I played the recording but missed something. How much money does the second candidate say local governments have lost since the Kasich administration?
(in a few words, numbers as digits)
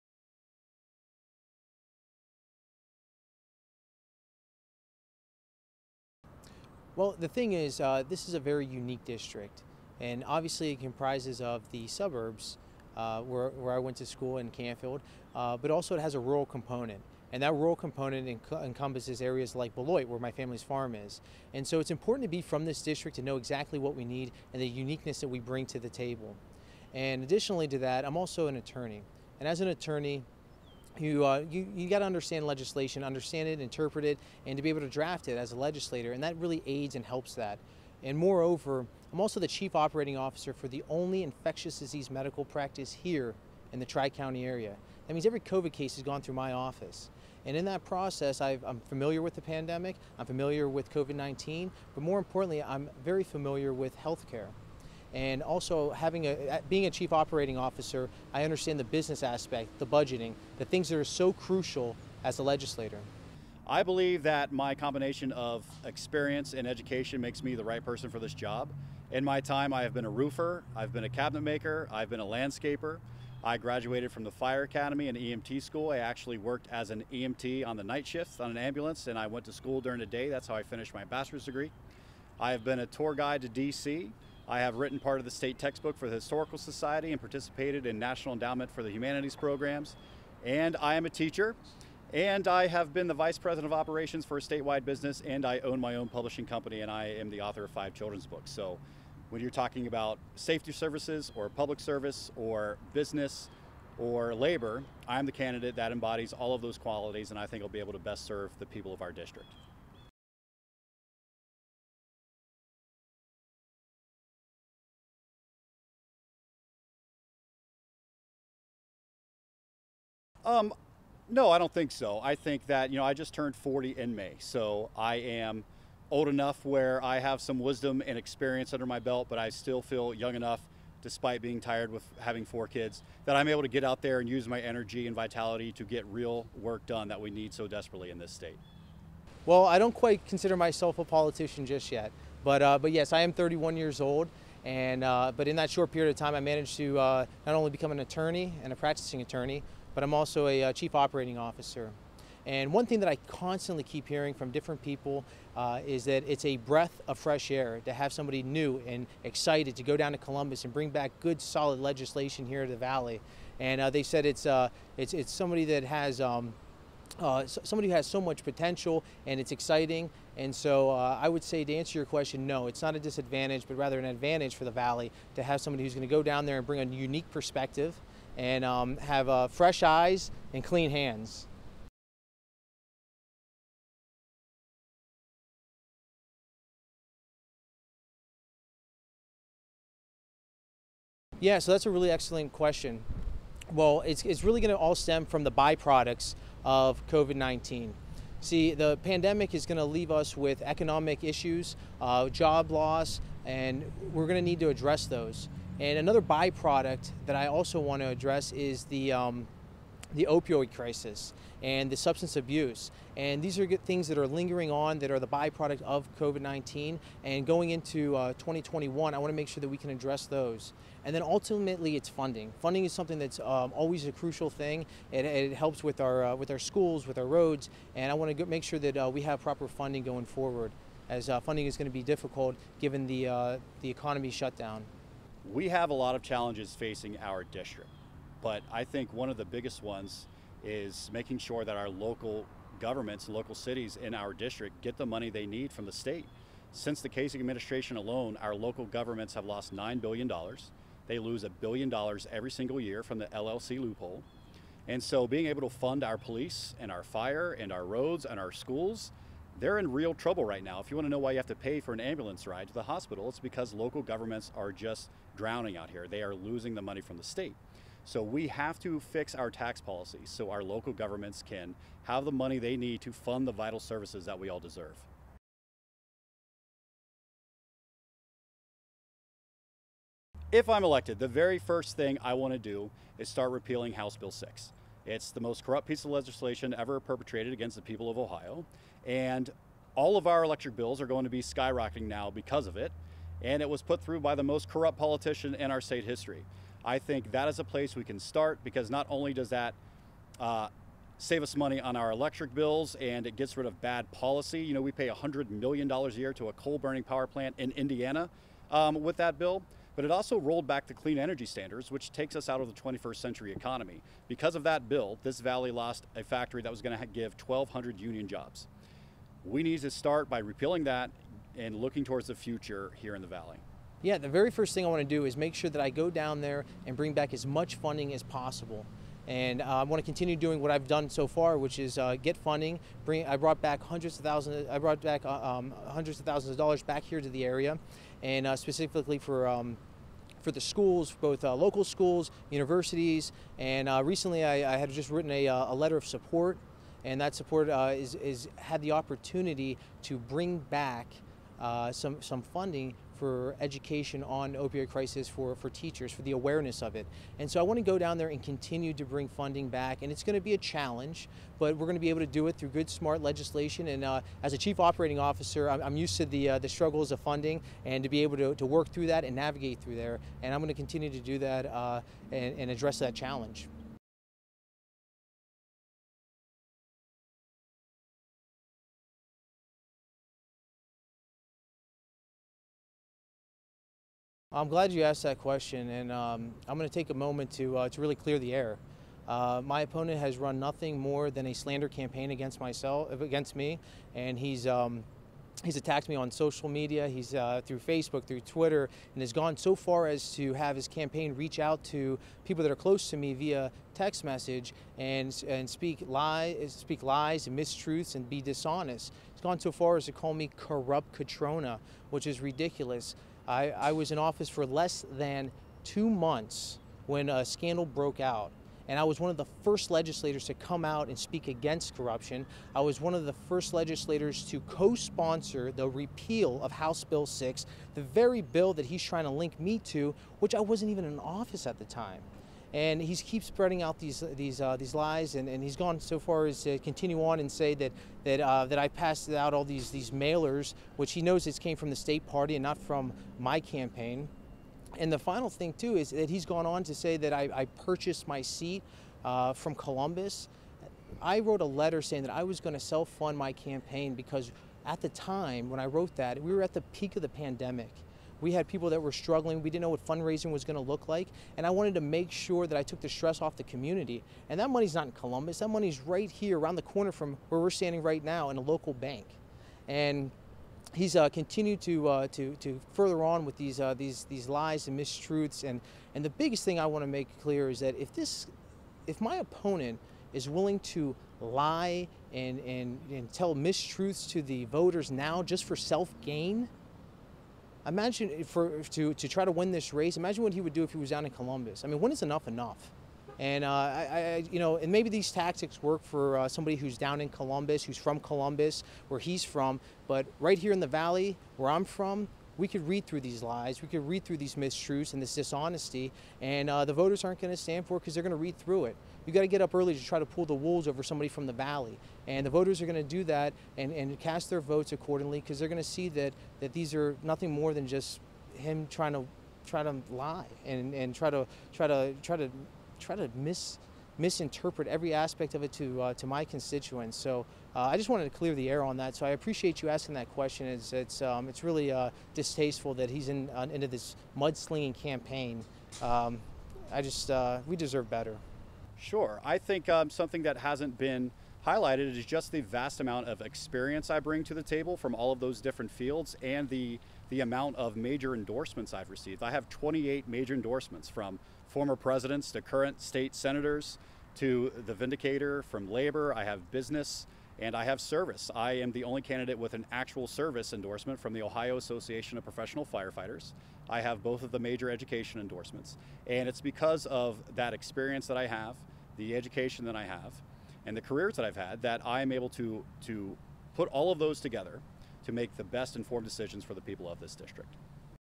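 $9 billion.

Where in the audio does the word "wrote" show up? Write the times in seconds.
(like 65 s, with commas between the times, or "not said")
451 s, 455 s.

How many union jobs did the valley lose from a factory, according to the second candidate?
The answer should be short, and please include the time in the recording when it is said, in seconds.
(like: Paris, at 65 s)
1,200, at 317 s.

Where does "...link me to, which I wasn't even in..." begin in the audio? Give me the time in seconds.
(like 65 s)
429 s.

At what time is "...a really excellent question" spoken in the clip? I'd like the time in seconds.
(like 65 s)
191 s.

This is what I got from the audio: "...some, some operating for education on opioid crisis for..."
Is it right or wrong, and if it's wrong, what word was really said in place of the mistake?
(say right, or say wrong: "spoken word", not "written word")
wrong: "funding", not "operating".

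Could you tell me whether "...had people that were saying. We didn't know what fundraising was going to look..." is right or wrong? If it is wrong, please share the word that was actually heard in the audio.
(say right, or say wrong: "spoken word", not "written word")
wrong: "struggling", not "saying".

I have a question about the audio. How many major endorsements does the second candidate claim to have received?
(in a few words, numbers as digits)
28.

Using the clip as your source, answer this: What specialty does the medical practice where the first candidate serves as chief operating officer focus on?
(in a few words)
Infectious disease.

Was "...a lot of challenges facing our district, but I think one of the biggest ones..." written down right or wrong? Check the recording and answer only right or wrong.
right.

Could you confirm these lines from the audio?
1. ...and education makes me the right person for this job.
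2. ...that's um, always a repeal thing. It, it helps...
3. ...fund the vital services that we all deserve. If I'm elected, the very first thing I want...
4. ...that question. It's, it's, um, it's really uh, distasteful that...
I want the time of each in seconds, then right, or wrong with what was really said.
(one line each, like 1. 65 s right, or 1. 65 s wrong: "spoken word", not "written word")
1. 66 s right
2. 223 s wrong: "crucial", not "repeal"
3. 273 s right
4. 530 s right.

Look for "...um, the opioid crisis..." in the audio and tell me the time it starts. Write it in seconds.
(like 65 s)
209 s.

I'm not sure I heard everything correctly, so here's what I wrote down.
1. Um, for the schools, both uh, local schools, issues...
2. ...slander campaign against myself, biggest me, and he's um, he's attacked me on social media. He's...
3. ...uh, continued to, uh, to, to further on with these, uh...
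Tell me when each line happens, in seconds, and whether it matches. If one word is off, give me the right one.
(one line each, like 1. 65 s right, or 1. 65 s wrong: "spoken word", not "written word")
1. 339 s wrong: "universities", not "issues"
2. 391 s wrong: "against", not "biggest"
3. 471 s right.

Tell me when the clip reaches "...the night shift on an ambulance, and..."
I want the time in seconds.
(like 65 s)
77 s.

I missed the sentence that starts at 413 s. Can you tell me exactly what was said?
I, I was in office for less than two months when a scandal broke out.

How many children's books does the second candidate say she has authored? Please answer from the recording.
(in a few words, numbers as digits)
5.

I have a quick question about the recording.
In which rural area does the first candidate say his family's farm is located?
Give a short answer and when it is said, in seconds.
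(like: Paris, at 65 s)
Beloit, at 19 s.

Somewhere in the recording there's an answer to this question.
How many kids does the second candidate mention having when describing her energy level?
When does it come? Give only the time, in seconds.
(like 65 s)
132 s.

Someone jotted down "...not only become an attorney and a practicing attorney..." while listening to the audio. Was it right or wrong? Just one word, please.
right.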